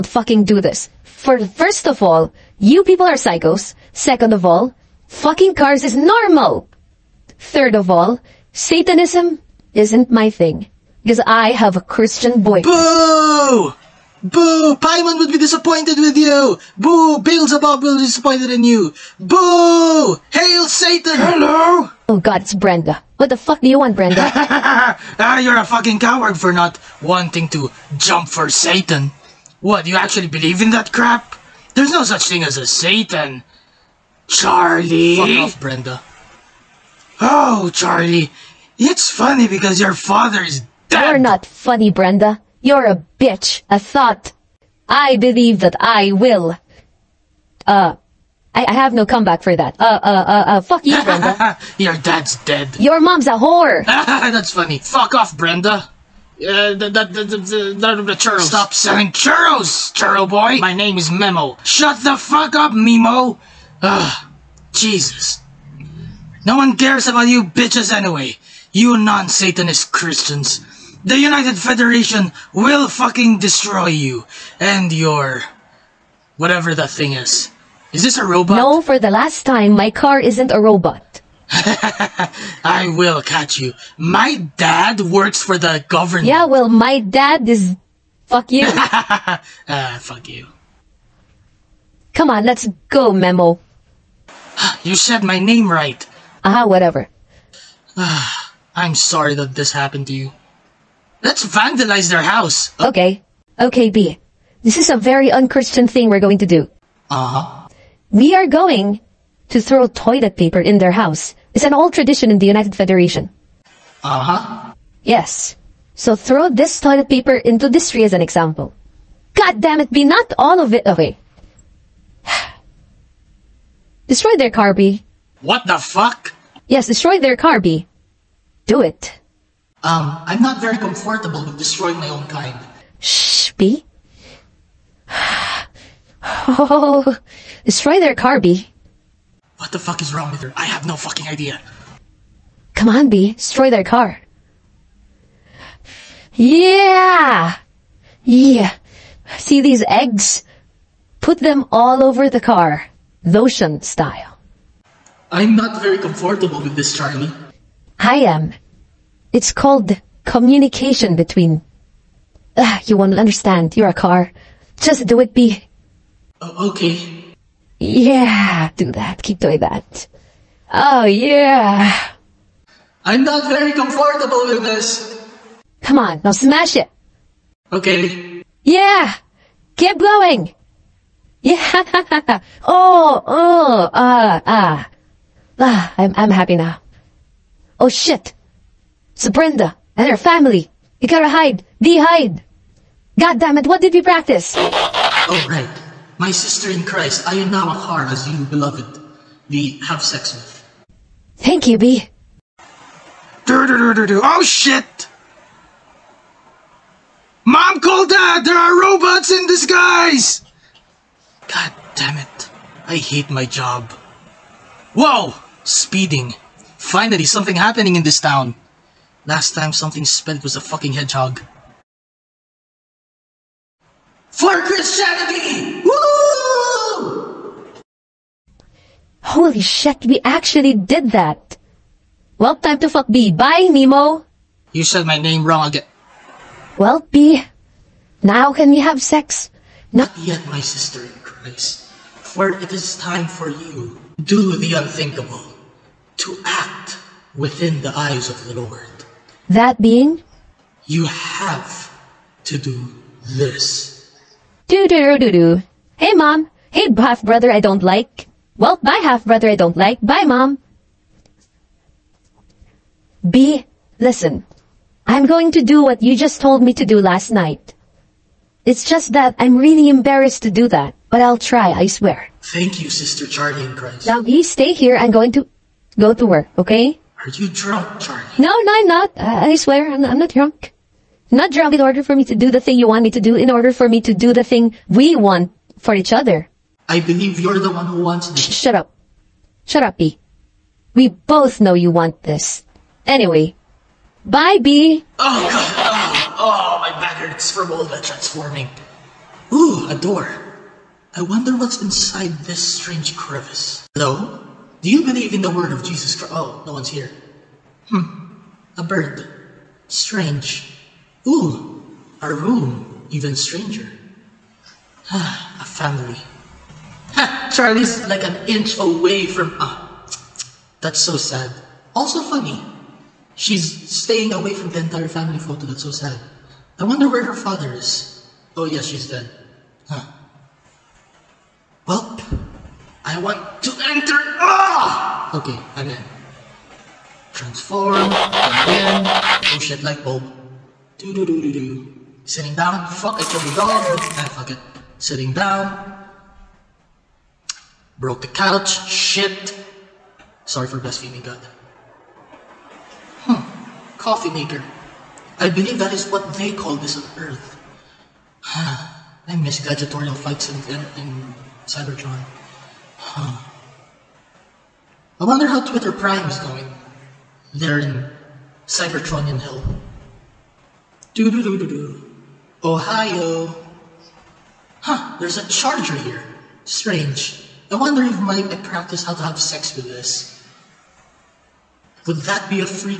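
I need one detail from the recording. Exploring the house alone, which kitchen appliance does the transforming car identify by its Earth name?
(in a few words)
Coffee maker.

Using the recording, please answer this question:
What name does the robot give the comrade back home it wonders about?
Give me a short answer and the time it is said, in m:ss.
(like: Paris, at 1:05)
Twitter Prime, at 6:05.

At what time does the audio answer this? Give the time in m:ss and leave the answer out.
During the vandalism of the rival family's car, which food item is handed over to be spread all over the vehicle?
2:29.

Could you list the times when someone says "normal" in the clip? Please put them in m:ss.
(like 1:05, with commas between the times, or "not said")
0:05.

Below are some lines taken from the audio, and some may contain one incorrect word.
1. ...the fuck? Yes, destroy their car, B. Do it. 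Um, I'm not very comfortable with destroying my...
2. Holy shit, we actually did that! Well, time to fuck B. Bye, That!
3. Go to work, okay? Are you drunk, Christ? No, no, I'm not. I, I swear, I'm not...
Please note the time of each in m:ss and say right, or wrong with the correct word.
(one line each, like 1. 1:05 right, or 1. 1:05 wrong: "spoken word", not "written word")
1. 2:05 right
2. 3:49 wrong: "Nemo", not "That"
3. 4:35 wrong: "Charlie", not "Christ".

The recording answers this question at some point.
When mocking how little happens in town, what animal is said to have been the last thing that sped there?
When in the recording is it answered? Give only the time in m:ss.
3:40.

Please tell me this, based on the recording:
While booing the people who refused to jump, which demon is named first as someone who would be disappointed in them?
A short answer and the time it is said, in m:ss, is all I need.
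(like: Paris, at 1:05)
Paimon, at 0:14.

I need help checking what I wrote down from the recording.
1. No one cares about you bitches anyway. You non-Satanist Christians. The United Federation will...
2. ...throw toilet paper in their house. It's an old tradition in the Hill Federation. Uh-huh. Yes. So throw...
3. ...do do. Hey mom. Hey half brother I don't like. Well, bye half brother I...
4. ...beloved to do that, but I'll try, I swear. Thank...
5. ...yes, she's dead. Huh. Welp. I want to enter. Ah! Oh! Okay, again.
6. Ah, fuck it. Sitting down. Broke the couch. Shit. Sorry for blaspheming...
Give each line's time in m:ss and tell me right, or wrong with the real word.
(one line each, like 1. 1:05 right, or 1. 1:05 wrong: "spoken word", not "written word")
1. 1:06 right
2. 1:49 wrong: "United", not "Hill"
3. 4:15 right
4. 4:29 wrong: "embarrassed", not "beloved"
5. 5:28 right
6. 5:44 right.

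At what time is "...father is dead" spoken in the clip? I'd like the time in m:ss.
0:39.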